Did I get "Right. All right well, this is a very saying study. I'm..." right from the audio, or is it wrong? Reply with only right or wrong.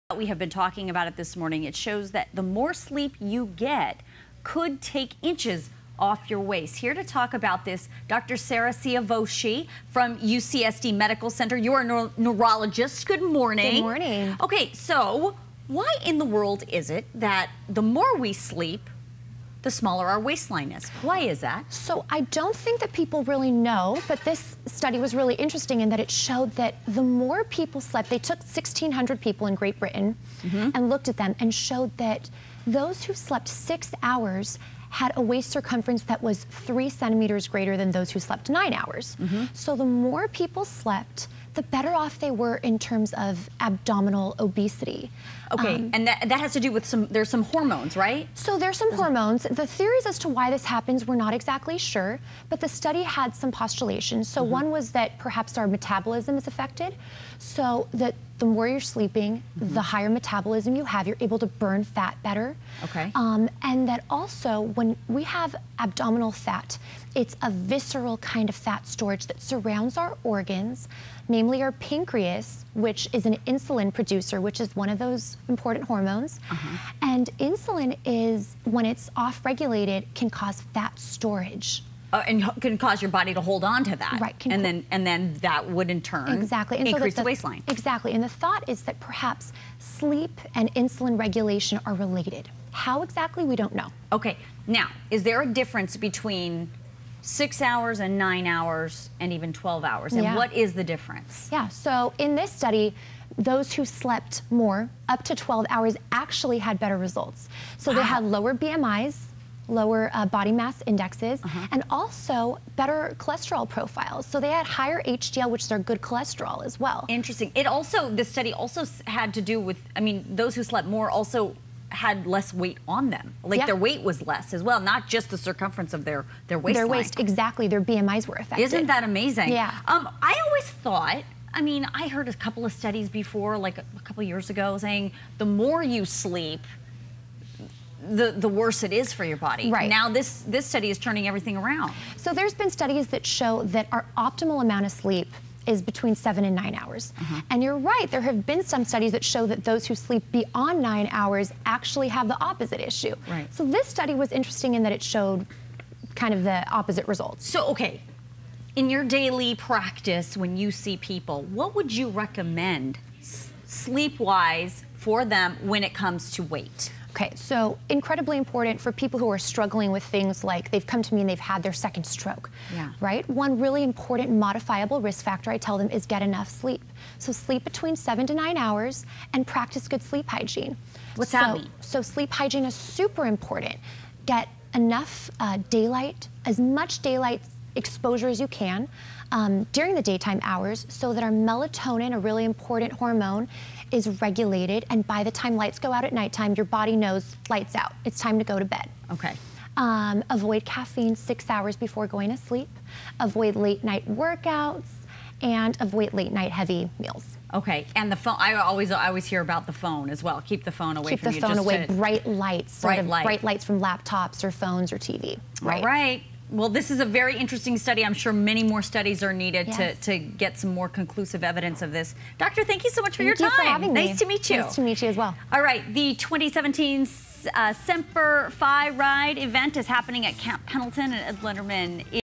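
wrong.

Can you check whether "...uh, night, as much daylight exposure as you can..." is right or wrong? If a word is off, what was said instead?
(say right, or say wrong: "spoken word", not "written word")
wrong: "daylight", not "night".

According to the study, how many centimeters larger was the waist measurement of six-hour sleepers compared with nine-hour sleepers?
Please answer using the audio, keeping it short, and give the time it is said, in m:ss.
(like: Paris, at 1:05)
3 centimeters, at 0:36.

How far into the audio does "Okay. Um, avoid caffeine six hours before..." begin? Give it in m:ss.
3:19.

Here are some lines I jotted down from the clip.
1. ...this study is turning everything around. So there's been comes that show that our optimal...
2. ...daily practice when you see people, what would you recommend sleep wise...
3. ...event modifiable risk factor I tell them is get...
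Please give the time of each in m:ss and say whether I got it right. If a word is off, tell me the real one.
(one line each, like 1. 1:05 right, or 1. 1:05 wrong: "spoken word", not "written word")
1. 2:20 wrong: "studies", not "comes"
2. 2:39 right
3. 2:53 wrong: "important", not "event".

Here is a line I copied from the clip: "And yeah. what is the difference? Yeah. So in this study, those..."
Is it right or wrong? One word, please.
right.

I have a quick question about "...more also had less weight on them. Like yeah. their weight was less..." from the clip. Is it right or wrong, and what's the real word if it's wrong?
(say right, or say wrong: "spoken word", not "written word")
right.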